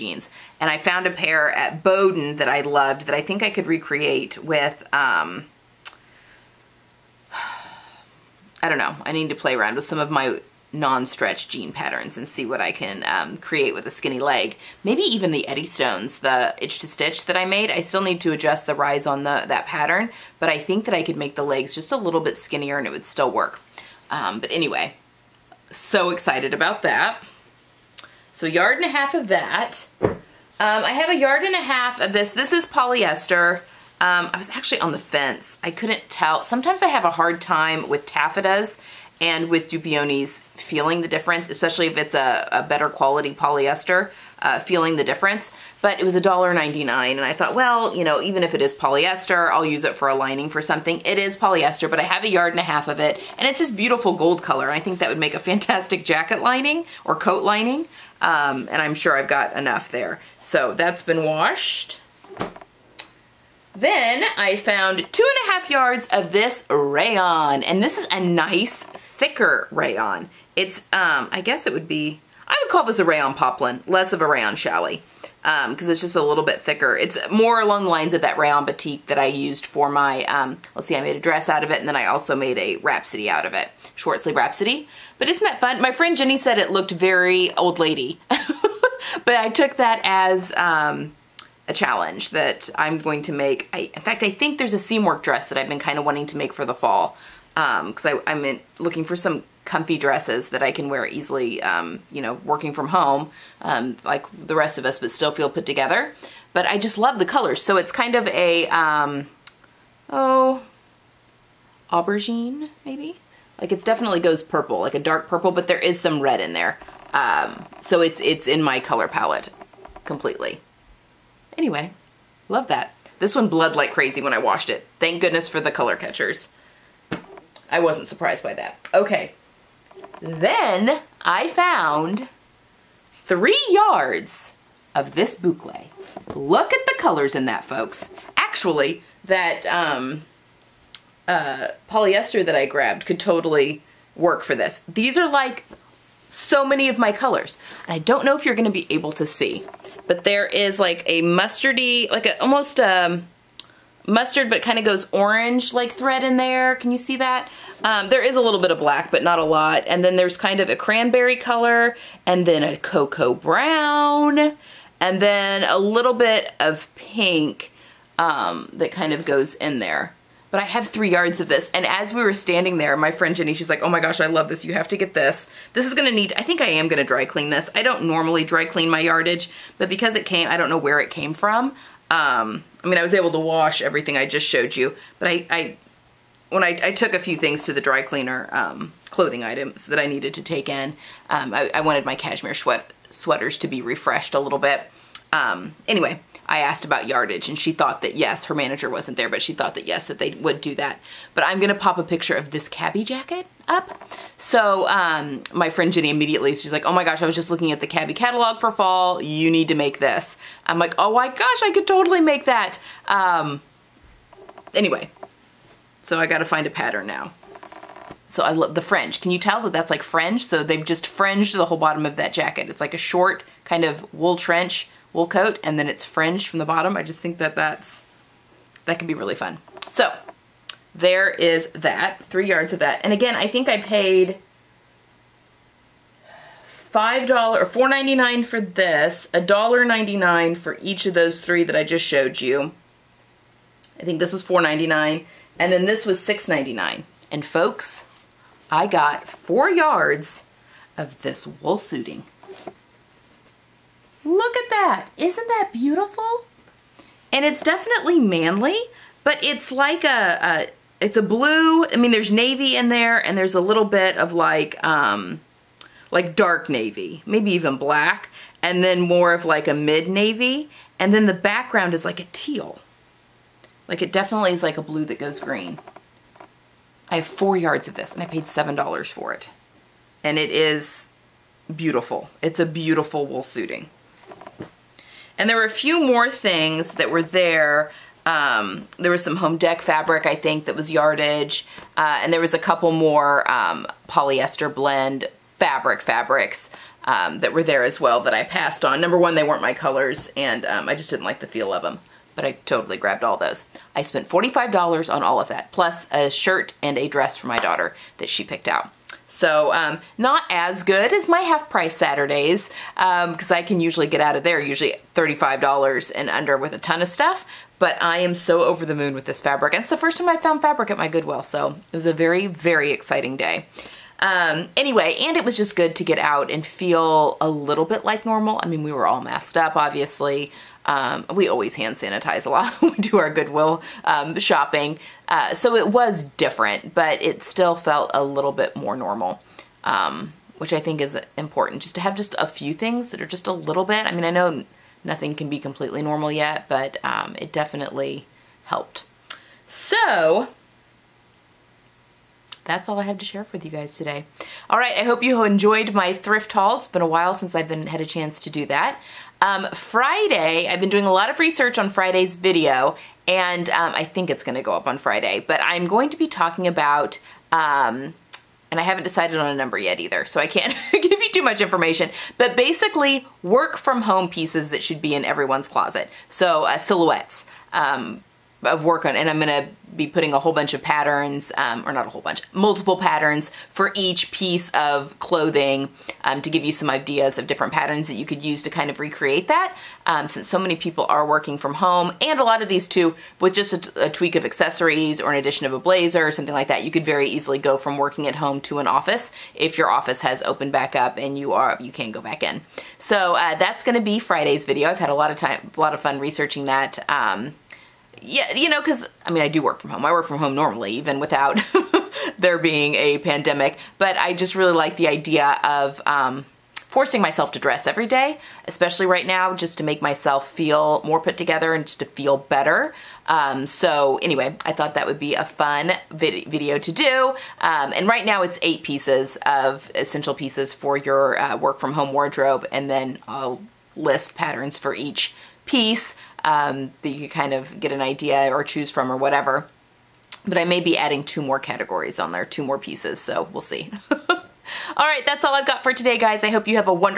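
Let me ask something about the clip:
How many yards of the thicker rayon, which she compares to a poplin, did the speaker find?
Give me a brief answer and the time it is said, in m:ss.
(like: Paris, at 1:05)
2.5, at 1:05.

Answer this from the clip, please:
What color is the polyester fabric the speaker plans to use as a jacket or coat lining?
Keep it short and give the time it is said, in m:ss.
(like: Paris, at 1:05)
gold, at 0:54.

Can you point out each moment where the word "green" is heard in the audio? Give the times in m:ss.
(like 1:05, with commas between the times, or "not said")
4:35.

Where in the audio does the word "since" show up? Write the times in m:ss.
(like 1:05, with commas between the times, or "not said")
5:57, 6:30.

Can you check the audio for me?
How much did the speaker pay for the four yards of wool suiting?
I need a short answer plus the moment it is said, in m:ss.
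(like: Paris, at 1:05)
$7, at 4:38.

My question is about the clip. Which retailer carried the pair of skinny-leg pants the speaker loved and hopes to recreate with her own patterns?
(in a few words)
Boden.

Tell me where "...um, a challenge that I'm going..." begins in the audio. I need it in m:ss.
1:30.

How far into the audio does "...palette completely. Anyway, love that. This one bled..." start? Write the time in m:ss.
1:59.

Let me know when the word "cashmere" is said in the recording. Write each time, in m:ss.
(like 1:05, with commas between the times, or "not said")
3:12.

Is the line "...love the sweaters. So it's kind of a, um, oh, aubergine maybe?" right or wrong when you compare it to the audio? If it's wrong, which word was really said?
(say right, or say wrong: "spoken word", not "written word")
wrong: "colors", not "sweaters".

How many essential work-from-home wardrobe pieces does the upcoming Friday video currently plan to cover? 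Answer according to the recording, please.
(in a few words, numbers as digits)
8.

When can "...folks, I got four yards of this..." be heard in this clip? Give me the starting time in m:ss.
4:07.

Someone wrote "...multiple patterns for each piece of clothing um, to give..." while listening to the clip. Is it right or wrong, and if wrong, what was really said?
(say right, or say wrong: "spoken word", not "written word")
right.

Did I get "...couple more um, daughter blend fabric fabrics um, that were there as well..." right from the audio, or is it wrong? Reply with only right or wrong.
wrong.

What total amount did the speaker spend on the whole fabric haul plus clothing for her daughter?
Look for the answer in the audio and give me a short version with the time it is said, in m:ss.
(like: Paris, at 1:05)
$45, at 5:04.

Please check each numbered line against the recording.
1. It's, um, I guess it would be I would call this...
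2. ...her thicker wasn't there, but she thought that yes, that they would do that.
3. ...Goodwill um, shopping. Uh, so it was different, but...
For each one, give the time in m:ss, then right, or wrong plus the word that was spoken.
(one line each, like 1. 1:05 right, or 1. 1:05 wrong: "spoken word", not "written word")
1. 1:10 right
2. 3:18 wrong: "manager", not "thicker"
3. 5:33 right.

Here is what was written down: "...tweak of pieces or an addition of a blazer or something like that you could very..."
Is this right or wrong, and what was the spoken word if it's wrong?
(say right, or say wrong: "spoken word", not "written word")
wrong: "accessories", not "pieces".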